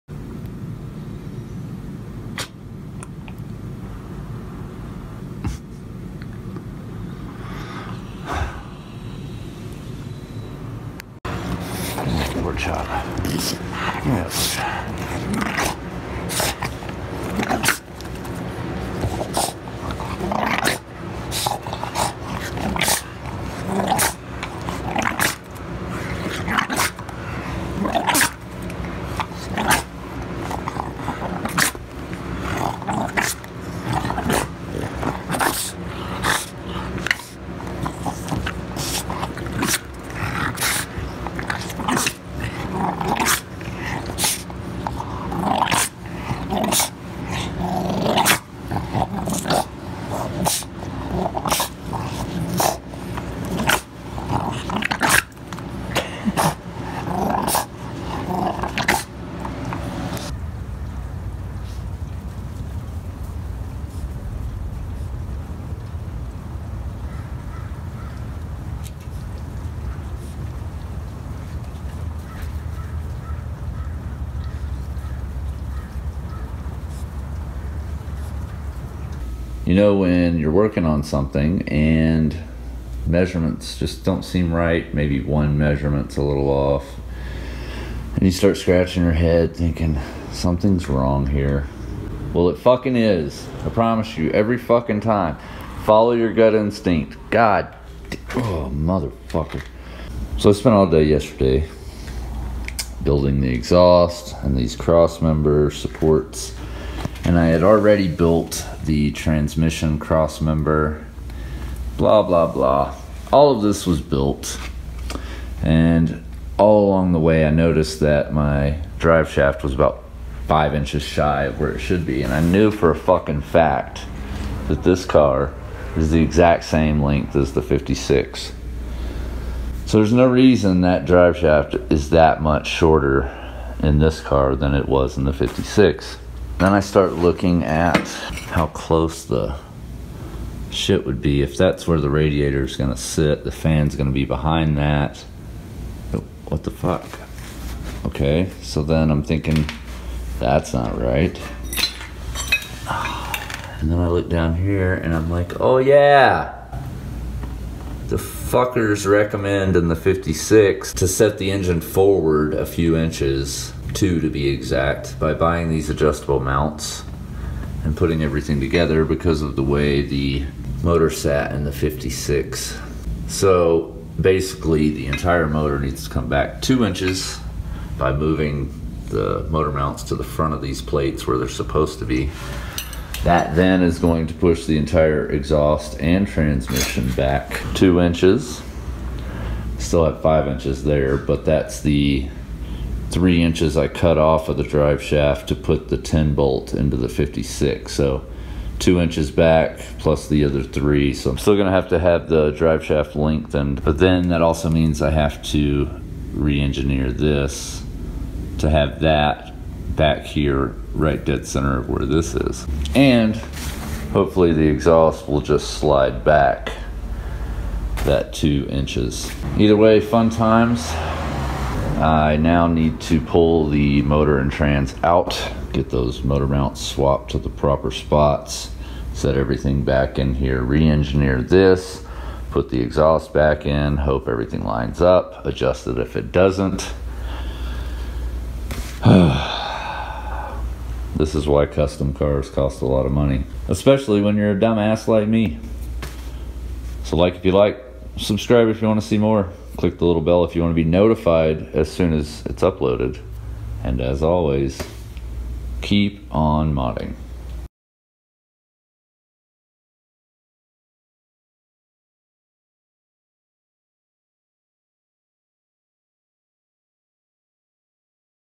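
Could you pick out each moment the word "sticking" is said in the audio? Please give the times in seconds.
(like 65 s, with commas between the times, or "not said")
not said.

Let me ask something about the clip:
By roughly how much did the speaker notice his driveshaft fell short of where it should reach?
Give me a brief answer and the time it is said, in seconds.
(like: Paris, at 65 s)
5 inches, at 119 s.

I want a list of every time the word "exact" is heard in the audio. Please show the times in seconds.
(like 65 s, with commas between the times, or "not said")
126 s, 164 s.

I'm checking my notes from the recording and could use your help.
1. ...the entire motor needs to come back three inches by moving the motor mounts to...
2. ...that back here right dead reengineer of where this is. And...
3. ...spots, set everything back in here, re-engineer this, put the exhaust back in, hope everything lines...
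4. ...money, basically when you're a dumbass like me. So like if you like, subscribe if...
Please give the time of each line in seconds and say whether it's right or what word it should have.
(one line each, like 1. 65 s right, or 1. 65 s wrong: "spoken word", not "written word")
1. 174 s wrong: "two", not "three"
2. 209 s wrong: "center", not "reengineer"
3. 227 s right
4. 243 s wrong: "especially", not "basically".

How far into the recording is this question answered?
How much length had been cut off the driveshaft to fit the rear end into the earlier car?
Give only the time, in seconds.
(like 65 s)
193 s.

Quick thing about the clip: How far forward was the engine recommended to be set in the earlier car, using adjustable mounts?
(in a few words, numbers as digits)
2 inches.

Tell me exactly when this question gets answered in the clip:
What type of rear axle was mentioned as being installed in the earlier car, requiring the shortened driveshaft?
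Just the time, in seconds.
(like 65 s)
195 s.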